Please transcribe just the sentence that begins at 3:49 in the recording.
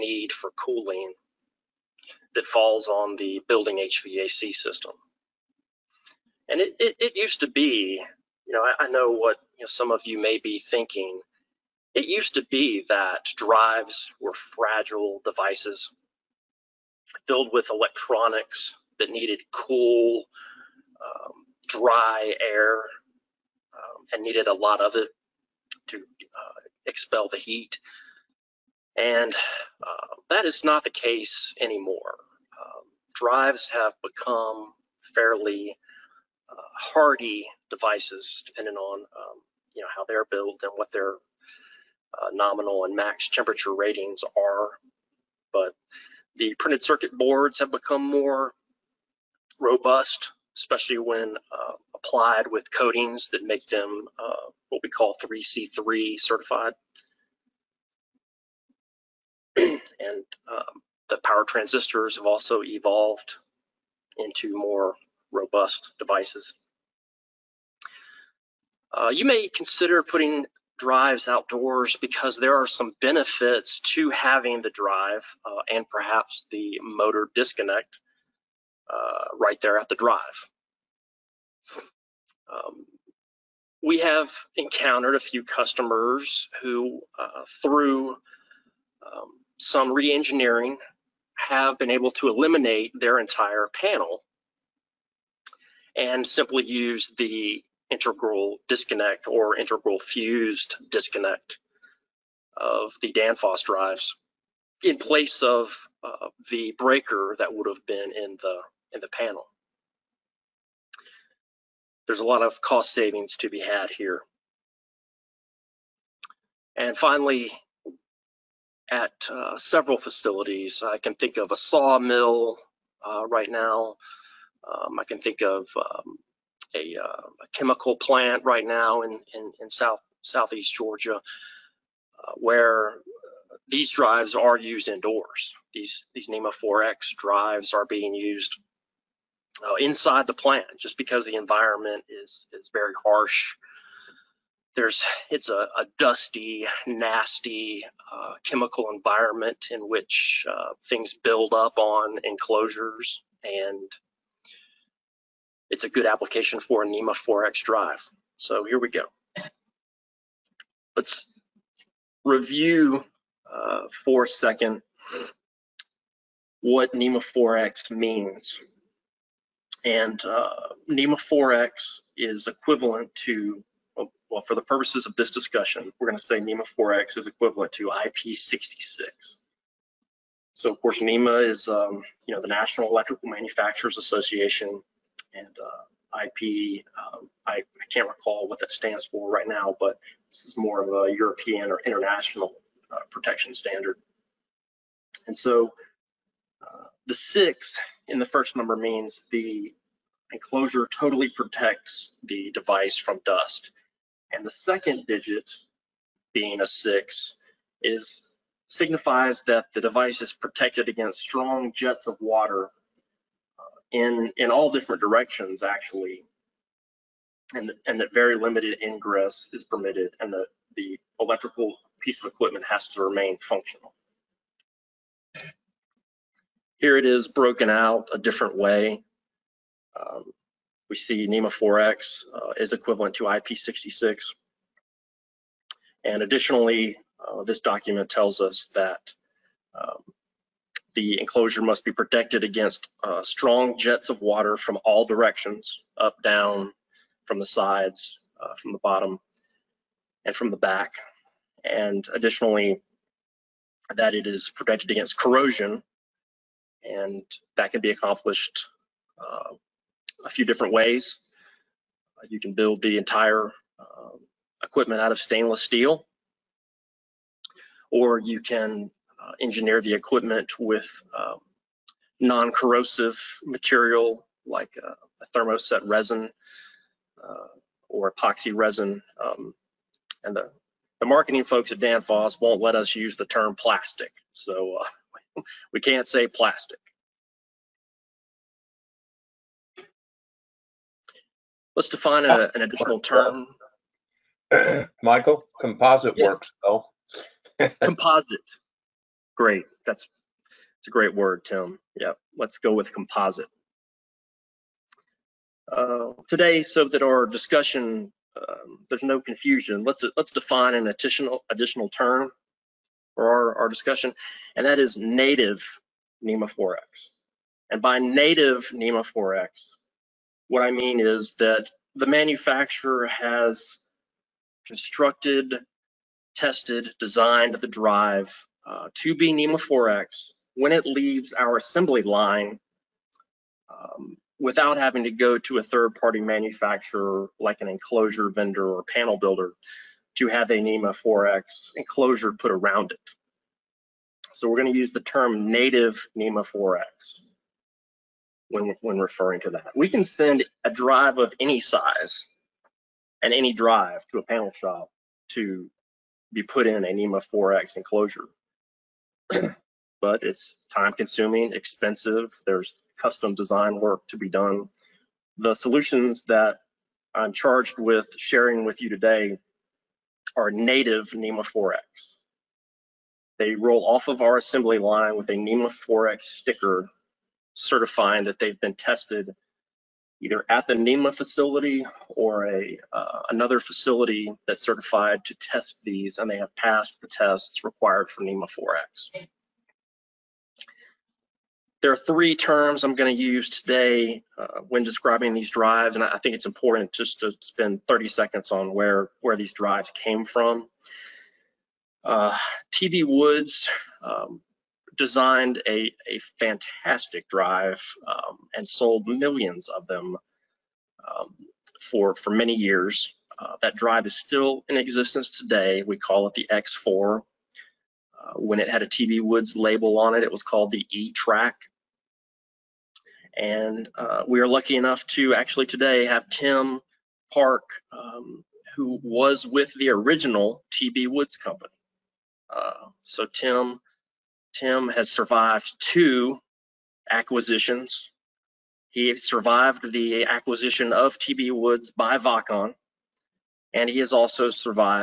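Um, we see NEMA 4X uh, is equivalent to IP66.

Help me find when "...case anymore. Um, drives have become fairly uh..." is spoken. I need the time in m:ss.
0:30.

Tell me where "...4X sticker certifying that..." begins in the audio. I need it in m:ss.
6:15.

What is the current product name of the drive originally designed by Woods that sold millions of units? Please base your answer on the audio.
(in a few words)
X4.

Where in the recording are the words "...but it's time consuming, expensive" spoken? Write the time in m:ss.
6:00.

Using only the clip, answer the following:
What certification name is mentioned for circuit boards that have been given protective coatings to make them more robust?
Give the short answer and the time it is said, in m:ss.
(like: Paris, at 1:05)
3C3, at 0:55.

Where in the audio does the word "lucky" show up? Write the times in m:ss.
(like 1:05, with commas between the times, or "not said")
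7:04.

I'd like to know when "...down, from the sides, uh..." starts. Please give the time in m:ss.
4:06.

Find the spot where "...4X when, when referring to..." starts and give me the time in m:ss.
5:46.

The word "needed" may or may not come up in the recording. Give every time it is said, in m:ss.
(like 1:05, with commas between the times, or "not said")
0:19, 0:24.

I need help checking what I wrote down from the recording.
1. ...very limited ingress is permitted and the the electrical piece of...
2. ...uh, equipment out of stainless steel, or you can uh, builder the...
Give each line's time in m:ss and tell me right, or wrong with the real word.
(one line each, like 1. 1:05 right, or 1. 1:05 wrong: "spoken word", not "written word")
1. 3:38 right
2. 4:23 wrong: "engineer", not "builder".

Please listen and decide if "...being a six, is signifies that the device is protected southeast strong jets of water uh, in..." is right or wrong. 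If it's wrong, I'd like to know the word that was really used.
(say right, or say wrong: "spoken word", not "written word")
wrong: "against", not "southeast".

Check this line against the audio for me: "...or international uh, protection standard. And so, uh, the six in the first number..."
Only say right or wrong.
right.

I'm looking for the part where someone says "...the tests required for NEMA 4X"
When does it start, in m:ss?
6:27.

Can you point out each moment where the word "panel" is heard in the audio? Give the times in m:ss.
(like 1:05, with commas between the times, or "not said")
1:33, 1:49, 5:38, 5:54.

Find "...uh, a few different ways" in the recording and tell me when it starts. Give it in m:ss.
4:19.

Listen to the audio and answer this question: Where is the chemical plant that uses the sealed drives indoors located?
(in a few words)
Southeast Georgia.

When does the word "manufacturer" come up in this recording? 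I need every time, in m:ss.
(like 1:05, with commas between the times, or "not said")
3:03, 5:22, 5:36.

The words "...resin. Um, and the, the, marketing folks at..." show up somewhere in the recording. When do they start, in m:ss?
4:38.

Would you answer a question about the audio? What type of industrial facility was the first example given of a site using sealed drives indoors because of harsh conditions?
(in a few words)
Sawmill.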